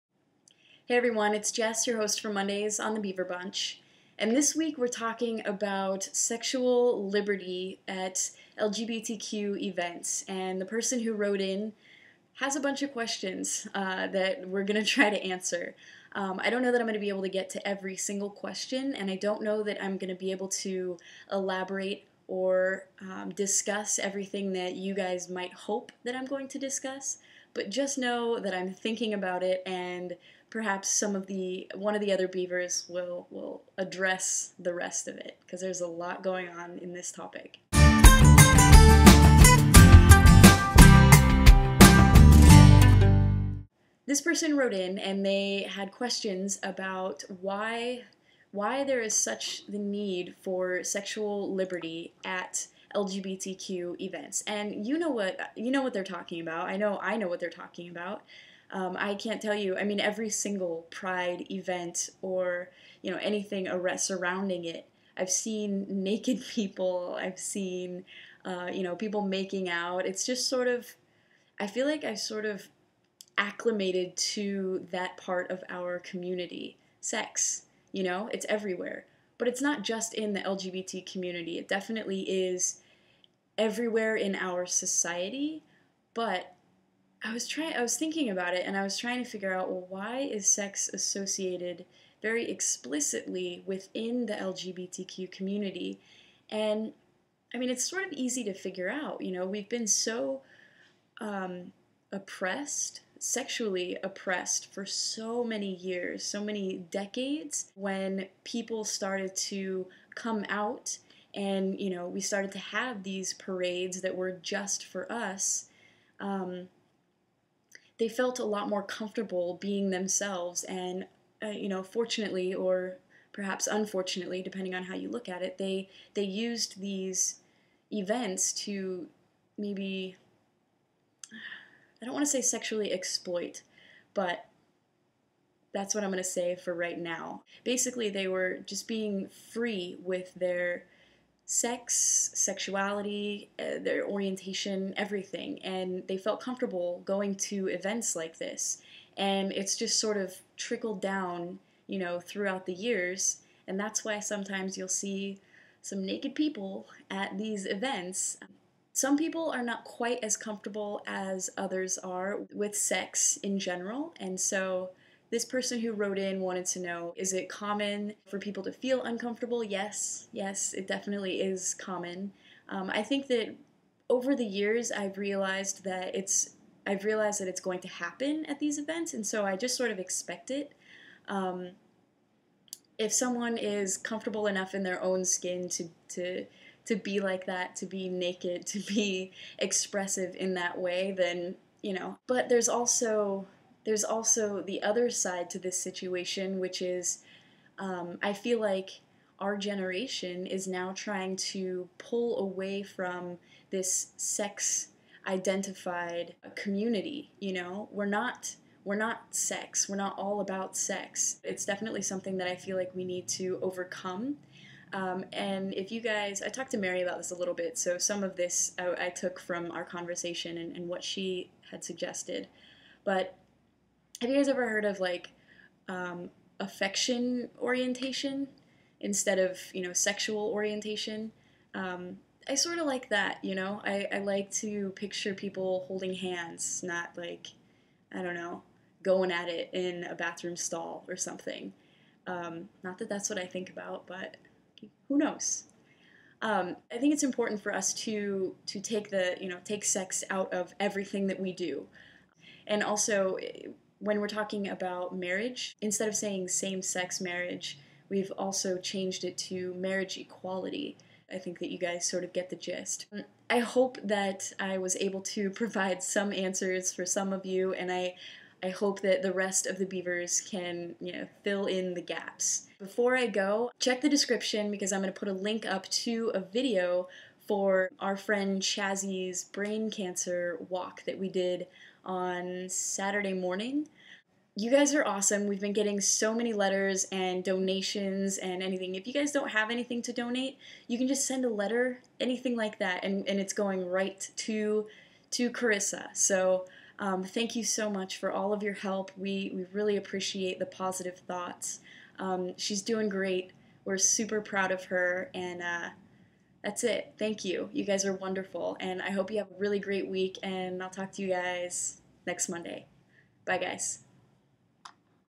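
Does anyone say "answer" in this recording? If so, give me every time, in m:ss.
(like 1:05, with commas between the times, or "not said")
0:15, 4:26.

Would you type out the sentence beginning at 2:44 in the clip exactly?
And so this person who wrote in wanted to know is it common for people to feel uncomfortable?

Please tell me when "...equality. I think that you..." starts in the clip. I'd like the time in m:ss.
4:20.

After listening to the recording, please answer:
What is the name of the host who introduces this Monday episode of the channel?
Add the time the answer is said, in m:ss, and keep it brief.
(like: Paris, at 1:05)
Jess, at 0:01.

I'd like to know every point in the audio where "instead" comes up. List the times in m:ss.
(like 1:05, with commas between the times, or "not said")
3:48, 4:15.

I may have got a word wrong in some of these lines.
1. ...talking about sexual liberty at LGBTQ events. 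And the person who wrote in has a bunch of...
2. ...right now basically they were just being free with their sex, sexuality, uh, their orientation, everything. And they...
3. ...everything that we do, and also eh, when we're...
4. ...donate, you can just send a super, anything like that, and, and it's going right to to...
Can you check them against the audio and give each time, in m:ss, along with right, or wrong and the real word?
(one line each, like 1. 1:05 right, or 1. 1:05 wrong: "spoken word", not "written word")
1. 0:04 right
2. 2:16 right
3. 4:10 right
4. 4:50 wrong: "letter", not "super".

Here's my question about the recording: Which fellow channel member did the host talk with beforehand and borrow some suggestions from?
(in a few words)
Mary.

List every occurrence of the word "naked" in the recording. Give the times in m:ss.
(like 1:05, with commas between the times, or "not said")
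1:06, 2:36, 3:08.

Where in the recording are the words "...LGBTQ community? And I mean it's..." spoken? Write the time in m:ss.
1:34.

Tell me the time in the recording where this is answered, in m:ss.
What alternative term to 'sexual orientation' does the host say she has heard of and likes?
3:46.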